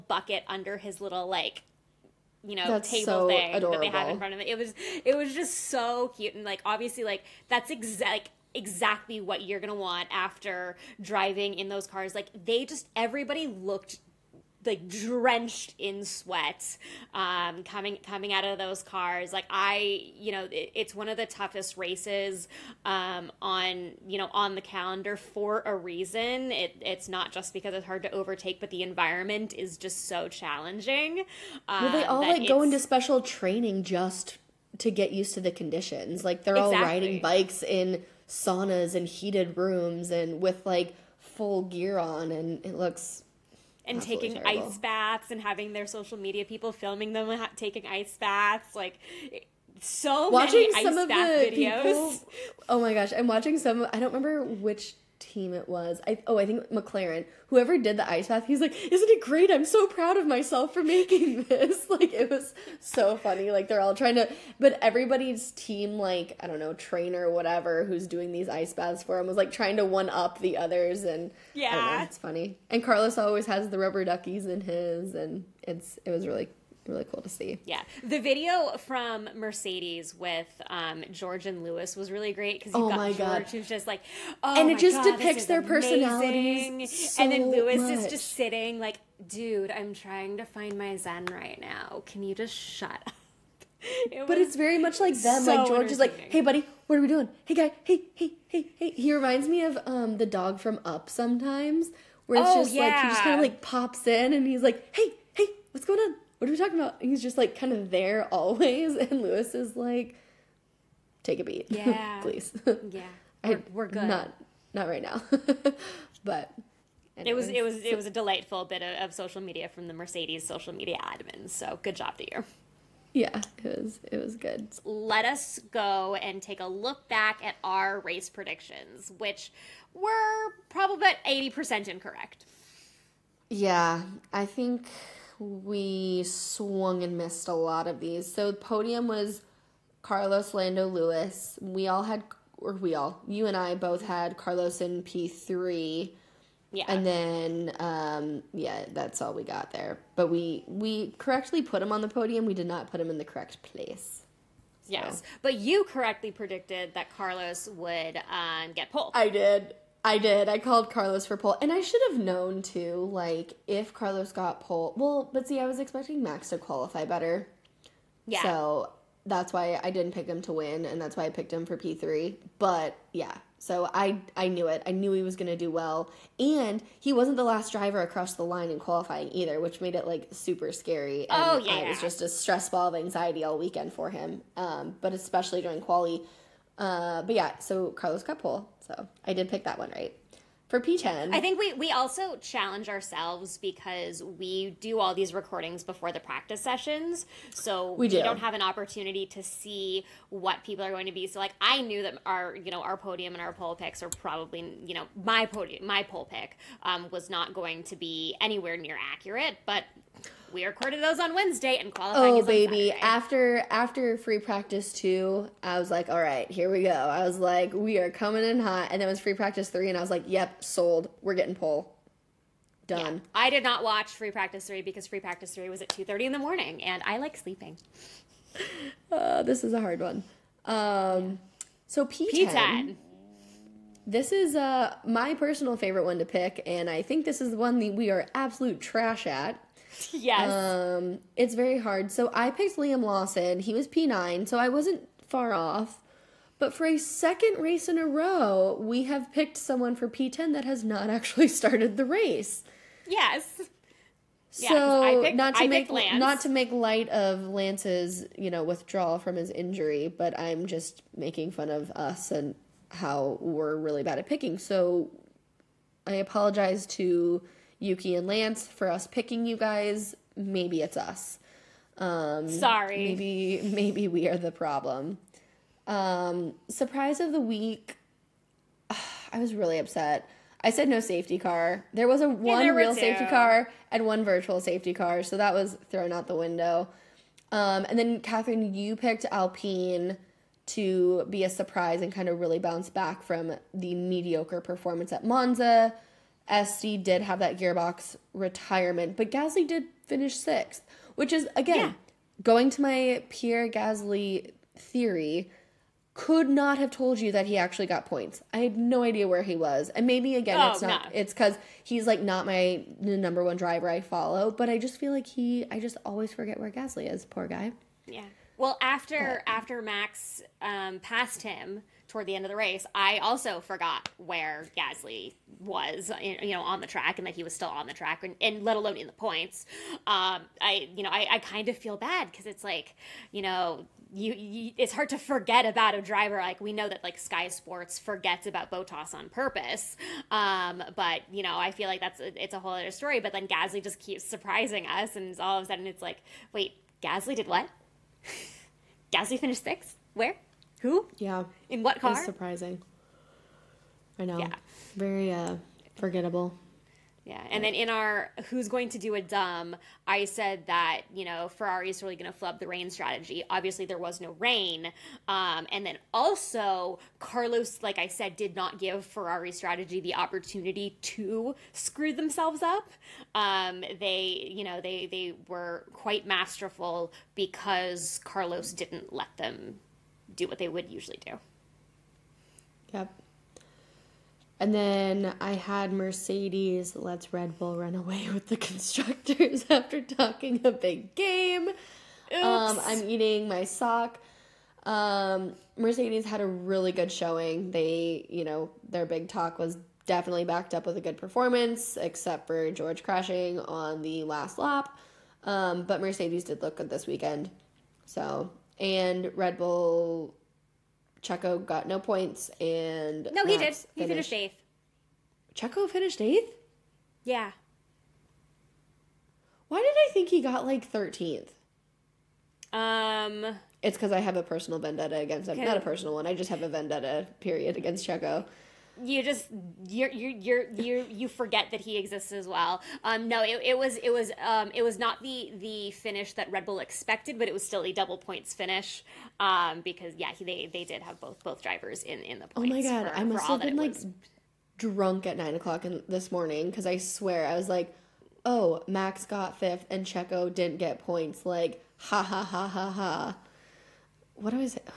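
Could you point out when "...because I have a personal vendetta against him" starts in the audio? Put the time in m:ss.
7:03.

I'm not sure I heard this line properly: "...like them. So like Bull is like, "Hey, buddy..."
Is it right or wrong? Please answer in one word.
wrong.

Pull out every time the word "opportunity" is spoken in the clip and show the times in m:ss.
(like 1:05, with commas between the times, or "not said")
3:18, 6:10.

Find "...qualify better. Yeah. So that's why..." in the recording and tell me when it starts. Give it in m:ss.
2:46.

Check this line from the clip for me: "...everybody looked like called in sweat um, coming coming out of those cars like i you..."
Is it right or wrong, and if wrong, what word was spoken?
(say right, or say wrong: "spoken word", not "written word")
wrong: "drenched", not "called".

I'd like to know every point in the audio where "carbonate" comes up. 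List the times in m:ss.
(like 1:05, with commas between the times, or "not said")
not said.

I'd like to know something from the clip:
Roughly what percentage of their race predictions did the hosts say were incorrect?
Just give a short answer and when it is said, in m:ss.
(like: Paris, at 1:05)
80%, at 2:11.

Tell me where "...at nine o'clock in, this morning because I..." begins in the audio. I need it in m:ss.
7:25.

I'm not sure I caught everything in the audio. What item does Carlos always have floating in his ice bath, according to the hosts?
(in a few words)
Rubber duckies.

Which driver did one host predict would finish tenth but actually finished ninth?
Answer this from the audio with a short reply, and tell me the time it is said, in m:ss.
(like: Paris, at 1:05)
Liam Lawson, at 4:02.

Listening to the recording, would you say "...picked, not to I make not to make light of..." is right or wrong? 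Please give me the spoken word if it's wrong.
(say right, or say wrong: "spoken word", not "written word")
right.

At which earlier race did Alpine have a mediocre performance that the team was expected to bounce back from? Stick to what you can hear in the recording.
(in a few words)
Monza.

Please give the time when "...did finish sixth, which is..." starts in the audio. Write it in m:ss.
4:59.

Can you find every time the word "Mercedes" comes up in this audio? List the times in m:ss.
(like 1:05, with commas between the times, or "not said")
1:19, 1:59, 6:25, 6:35, 6:46.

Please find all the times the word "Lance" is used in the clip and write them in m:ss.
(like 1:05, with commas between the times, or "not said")
4:17, 4:28.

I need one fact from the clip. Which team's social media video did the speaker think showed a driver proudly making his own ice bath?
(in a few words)
McLaren.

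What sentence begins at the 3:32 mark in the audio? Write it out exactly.
Oh baby, after after free practice two, I was like, all right, here we go.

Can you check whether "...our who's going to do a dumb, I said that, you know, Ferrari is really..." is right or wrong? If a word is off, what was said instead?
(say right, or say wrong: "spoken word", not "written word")
right.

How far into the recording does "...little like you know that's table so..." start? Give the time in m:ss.
0:00.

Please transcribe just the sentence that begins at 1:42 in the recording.
like he just kind of like pops in and he's like, "Hey, hey, what's going on?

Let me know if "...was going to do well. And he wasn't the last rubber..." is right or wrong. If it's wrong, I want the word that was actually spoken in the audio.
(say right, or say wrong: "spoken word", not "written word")
wrong: "driver", not "rubber".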